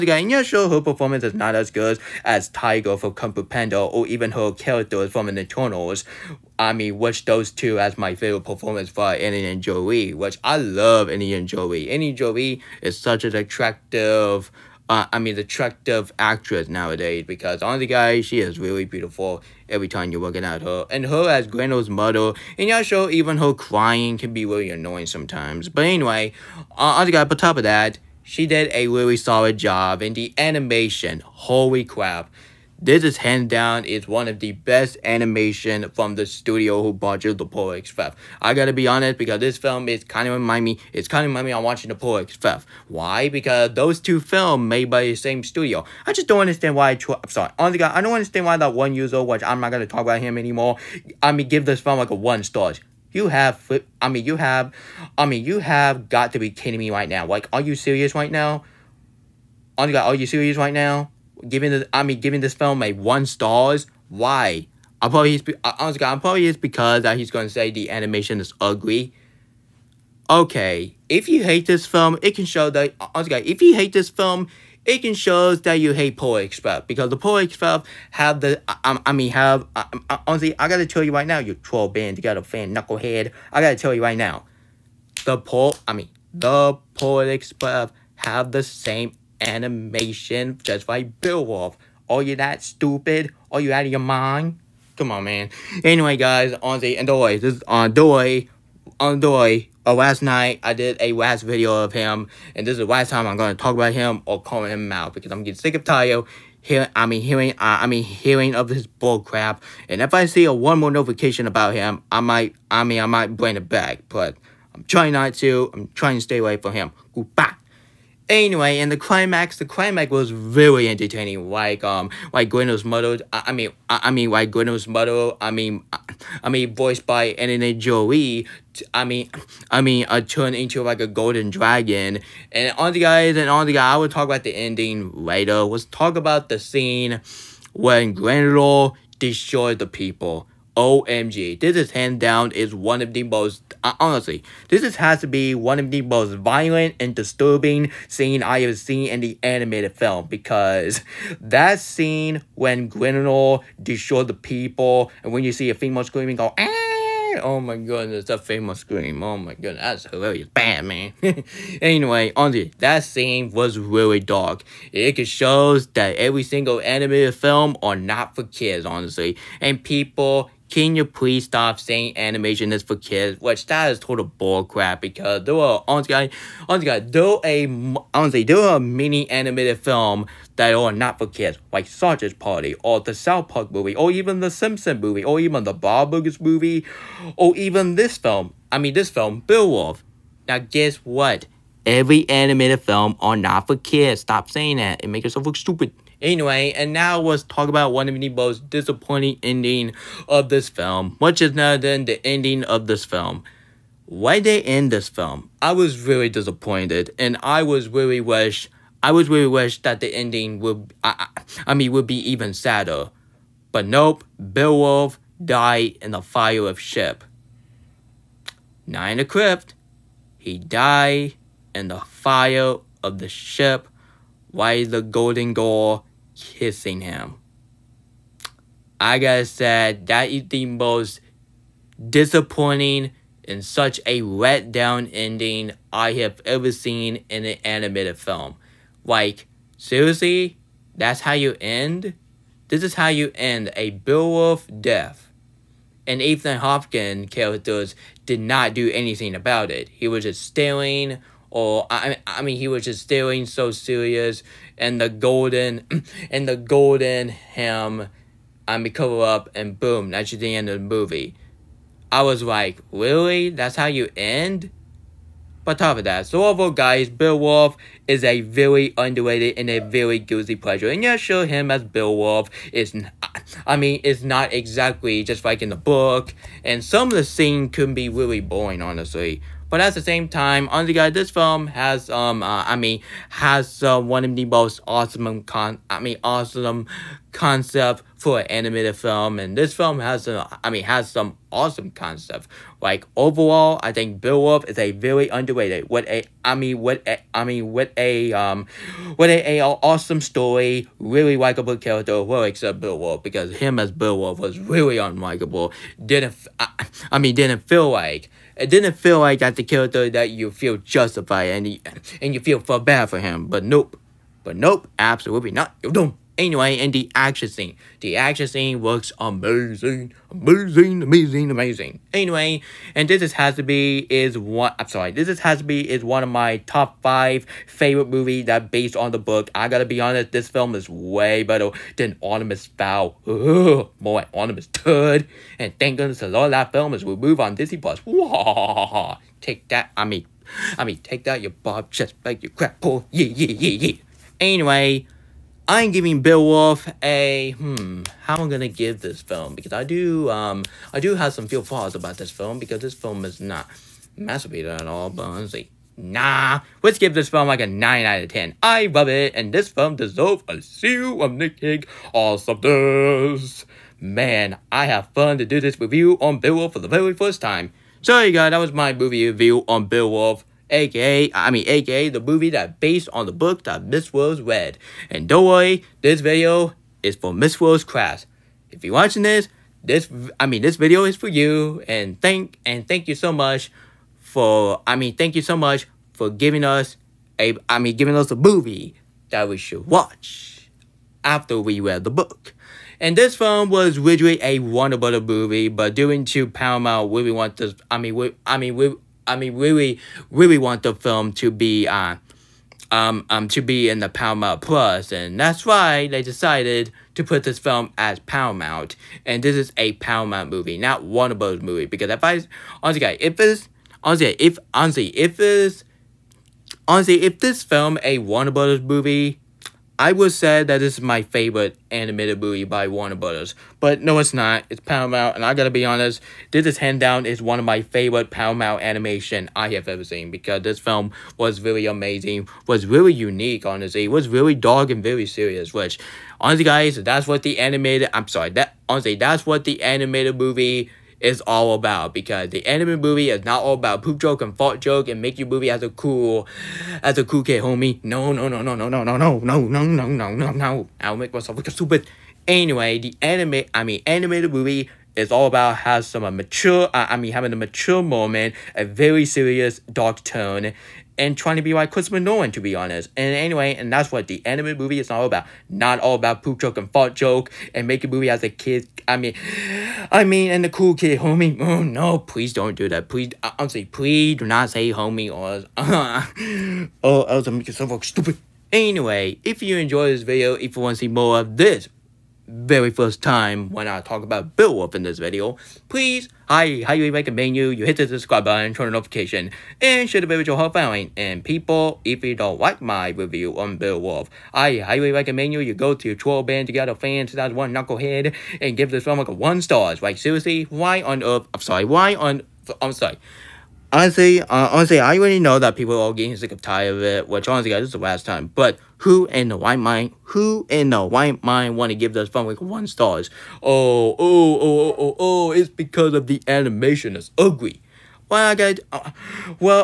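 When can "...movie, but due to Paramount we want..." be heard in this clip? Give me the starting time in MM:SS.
06:35.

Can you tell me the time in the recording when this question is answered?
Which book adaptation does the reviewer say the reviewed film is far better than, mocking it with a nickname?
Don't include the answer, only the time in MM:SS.
05:32.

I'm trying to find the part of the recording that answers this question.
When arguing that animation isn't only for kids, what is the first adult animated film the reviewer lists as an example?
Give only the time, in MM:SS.
03:01.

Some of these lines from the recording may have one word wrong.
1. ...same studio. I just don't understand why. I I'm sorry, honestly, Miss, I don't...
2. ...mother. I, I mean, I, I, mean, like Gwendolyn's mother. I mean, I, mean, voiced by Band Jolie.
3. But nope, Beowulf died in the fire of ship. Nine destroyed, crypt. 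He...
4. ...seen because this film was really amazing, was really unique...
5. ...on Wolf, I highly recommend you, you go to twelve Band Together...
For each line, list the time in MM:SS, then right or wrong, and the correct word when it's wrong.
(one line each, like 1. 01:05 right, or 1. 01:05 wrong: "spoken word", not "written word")
1. 00:45 wrong: "God", not "Miss"
2. 02:02 wrong: "Angelina", not "Band"
3. 03:33 wrong: "equipped", not "destroyed"
4. 07:10 right
5. 08:13 right.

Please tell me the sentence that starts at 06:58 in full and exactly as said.
movie, I would say that this is my favorite animated movie by Warner Brothers, but no, it's not.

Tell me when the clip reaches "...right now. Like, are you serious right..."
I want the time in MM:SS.
00:56.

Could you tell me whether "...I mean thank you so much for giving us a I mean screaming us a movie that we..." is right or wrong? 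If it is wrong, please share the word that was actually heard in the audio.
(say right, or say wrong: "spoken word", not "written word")
wrong: "giving", not "screaming".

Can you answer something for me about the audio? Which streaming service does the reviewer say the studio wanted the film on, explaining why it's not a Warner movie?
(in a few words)
Paramount Plus.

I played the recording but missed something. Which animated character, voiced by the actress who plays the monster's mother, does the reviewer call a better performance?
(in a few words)
Tiger.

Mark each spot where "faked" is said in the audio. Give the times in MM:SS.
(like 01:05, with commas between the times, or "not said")
not said.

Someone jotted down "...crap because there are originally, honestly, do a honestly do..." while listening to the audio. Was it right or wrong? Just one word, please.
wrong.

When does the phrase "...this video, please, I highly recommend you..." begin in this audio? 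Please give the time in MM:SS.
08:05.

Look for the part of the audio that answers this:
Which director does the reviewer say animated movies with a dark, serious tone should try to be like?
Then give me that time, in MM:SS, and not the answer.
07:41.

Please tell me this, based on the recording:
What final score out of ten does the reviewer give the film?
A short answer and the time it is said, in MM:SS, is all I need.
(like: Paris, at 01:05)
9, at 05:57.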